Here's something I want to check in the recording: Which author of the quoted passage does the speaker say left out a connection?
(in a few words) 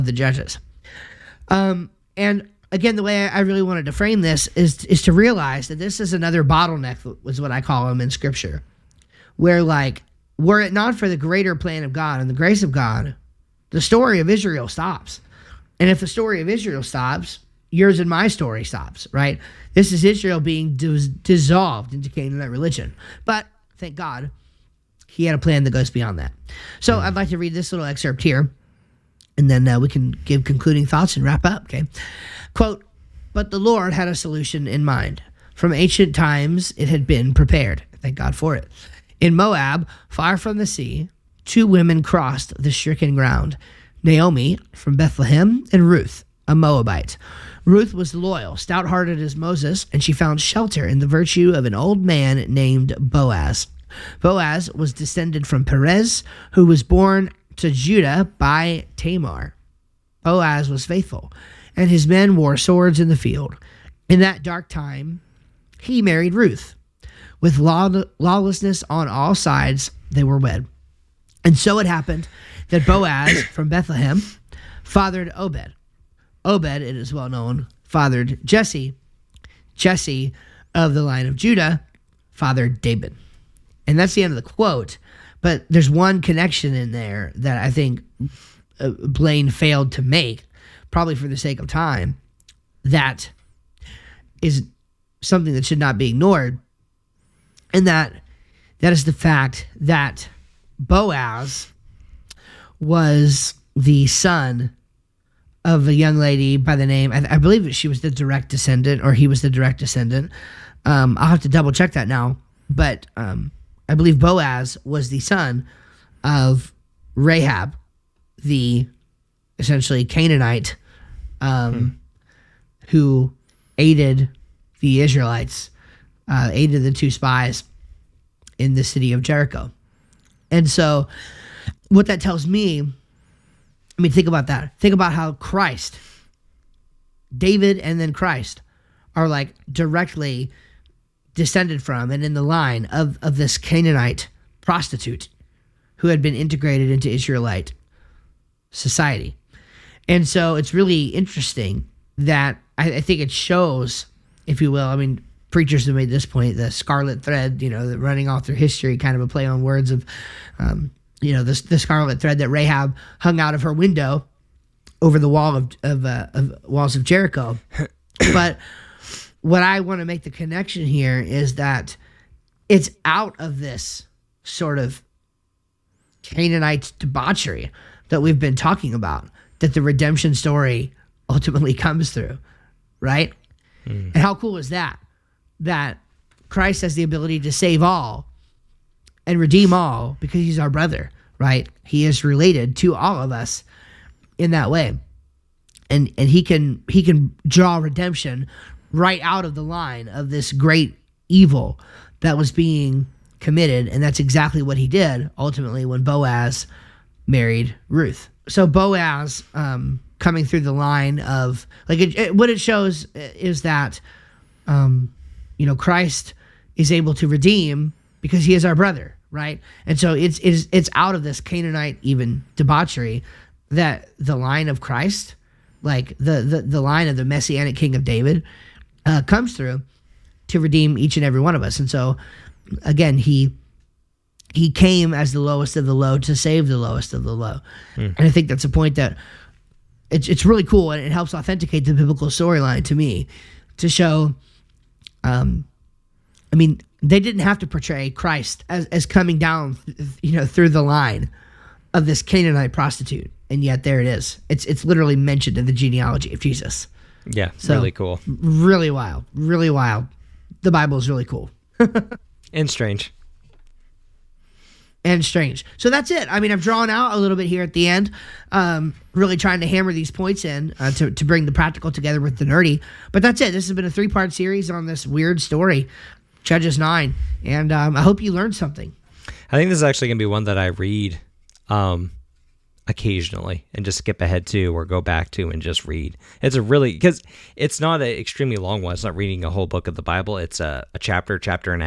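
Blaine.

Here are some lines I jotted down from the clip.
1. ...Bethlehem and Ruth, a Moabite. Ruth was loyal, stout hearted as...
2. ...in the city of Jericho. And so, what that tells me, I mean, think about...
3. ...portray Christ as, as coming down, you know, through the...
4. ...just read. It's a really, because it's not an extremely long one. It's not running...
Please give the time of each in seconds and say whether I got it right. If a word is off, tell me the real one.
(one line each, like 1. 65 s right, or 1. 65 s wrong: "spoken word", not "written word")
1. 44 s right
2. 128 s right
3. 247 s right
4. 285 s wrong: "reading", not "running".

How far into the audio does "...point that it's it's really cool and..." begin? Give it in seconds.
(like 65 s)
238 s.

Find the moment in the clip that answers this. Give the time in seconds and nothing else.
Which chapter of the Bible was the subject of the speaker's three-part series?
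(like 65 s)
276 s.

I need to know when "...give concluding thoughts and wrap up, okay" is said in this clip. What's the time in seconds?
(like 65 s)
30 s.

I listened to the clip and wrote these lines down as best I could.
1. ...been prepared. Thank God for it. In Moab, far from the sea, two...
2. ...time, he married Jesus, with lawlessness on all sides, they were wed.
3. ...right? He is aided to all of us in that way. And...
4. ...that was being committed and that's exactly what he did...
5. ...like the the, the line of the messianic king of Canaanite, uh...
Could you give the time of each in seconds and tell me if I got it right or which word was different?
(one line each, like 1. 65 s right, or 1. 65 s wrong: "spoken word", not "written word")
1. 37 s right
2. 64 s wrong: "Ruth", not "Jesus"
3. 191 s wrong: "related", not "aided"
4. 202 s right
5. 225 s wrong: "David", not "Canaanite".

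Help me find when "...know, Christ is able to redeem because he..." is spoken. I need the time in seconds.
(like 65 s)
215 s.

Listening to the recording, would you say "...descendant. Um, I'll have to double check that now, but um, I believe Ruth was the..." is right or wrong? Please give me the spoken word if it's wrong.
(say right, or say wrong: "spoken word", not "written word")
wrong: "Boaz", not "Ruth".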